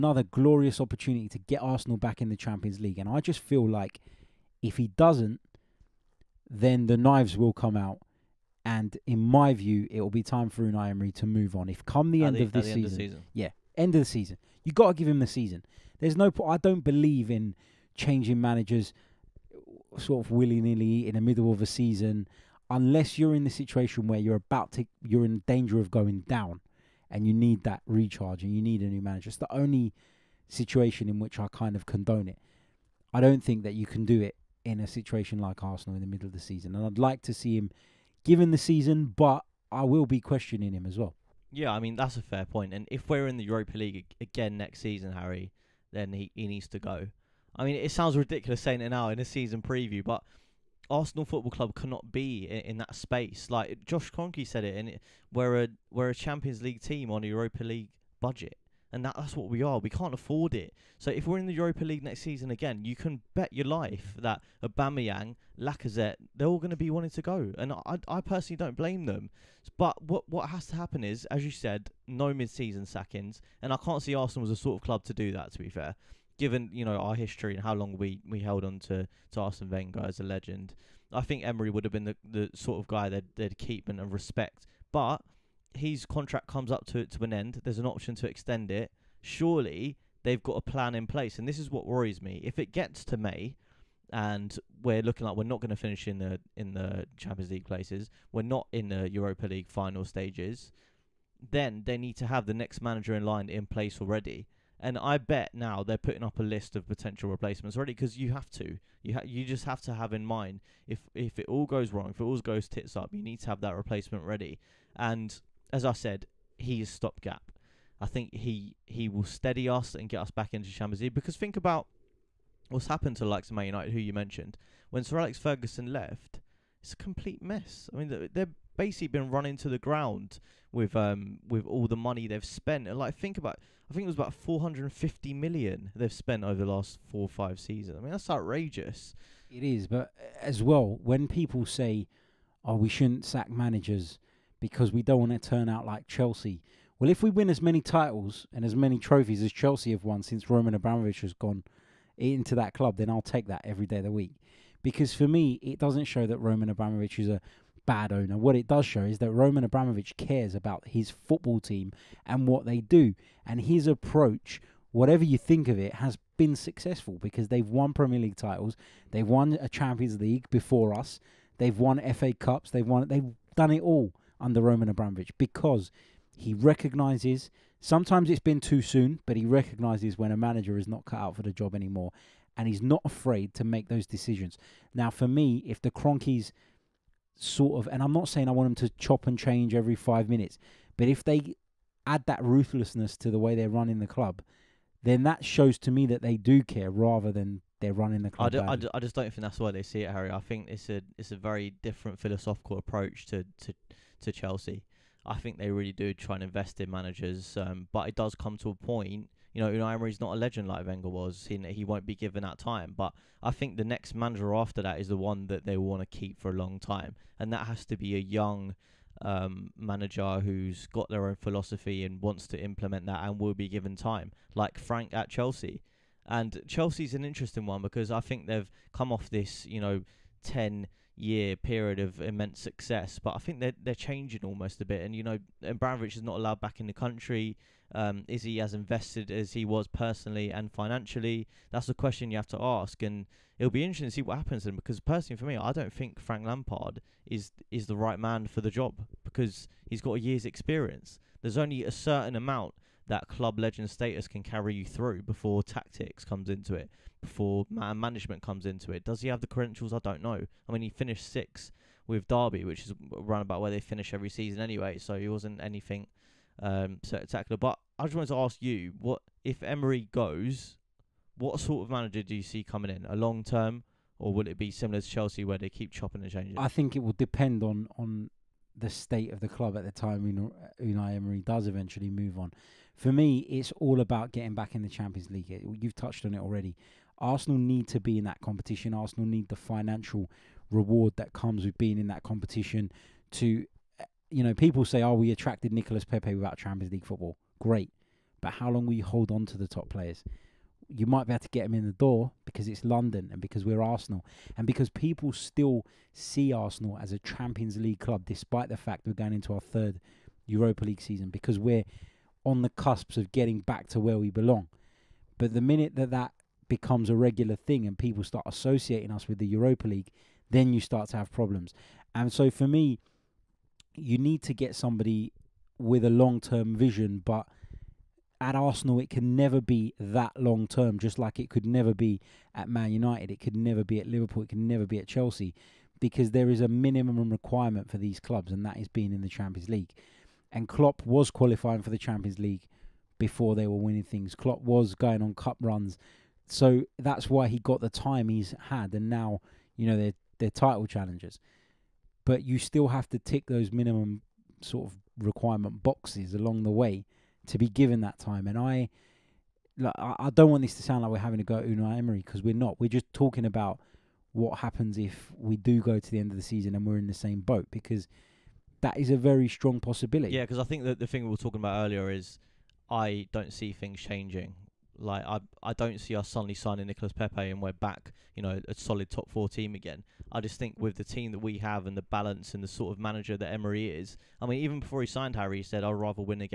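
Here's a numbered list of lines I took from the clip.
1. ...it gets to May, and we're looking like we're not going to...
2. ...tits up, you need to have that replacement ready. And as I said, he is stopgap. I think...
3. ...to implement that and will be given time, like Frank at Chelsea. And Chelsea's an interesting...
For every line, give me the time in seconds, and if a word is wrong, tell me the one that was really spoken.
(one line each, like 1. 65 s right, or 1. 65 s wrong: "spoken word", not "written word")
1. 92 s right
2. 112 s right
3. 222 s right.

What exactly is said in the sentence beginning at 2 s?
And I just feel like if he doesn't, then the knives will come out.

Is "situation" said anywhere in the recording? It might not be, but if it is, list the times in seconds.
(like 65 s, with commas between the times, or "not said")
23 s, 30 s, 34 s.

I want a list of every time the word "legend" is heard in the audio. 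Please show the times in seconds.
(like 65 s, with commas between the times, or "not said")
80 s, 210 s, 253 s.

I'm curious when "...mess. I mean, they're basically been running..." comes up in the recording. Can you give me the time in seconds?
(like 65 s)
127 s.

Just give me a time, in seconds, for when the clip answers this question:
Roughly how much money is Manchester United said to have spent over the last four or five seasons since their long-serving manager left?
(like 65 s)
134 s.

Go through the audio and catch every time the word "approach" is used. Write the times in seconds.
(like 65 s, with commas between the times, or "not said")
163 s, 202 s.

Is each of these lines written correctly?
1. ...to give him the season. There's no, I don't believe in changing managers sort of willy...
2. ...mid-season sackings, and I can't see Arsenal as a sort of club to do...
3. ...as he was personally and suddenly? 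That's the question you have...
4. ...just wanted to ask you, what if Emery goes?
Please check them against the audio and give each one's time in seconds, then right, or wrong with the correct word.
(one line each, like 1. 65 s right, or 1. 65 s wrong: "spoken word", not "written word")
1. 14 s right
2. 72 s right
3. 239 s wrong: "financially", not "suddenly"
4. 268 s right.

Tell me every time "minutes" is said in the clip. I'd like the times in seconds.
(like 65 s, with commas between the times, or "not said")
190 s, 315 s.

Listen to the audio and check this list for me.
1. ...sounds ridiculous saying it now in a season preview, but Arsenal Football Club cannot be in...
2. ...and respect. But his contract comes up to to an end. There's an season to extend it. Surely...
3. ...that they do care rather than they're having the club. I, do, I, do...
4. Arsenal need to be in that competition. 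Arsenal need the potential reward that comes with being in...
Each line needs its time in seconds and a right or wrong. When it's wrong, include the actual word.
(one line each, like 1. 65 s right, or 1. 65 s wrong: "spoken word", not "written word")
1. 47 s right
2. 83 s wrong: "option", not "season"
3. 196 s wrong: "running", not "having"
4. 287 s wrong: "financial", not "potential".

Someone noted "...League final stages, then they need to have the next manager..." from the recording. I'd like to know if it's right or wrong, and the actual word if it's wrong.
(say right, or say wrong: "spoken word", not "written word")
right.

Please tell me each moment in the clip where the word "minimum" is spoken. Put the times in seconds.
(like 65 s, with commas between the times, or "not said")
336 s, 353 s.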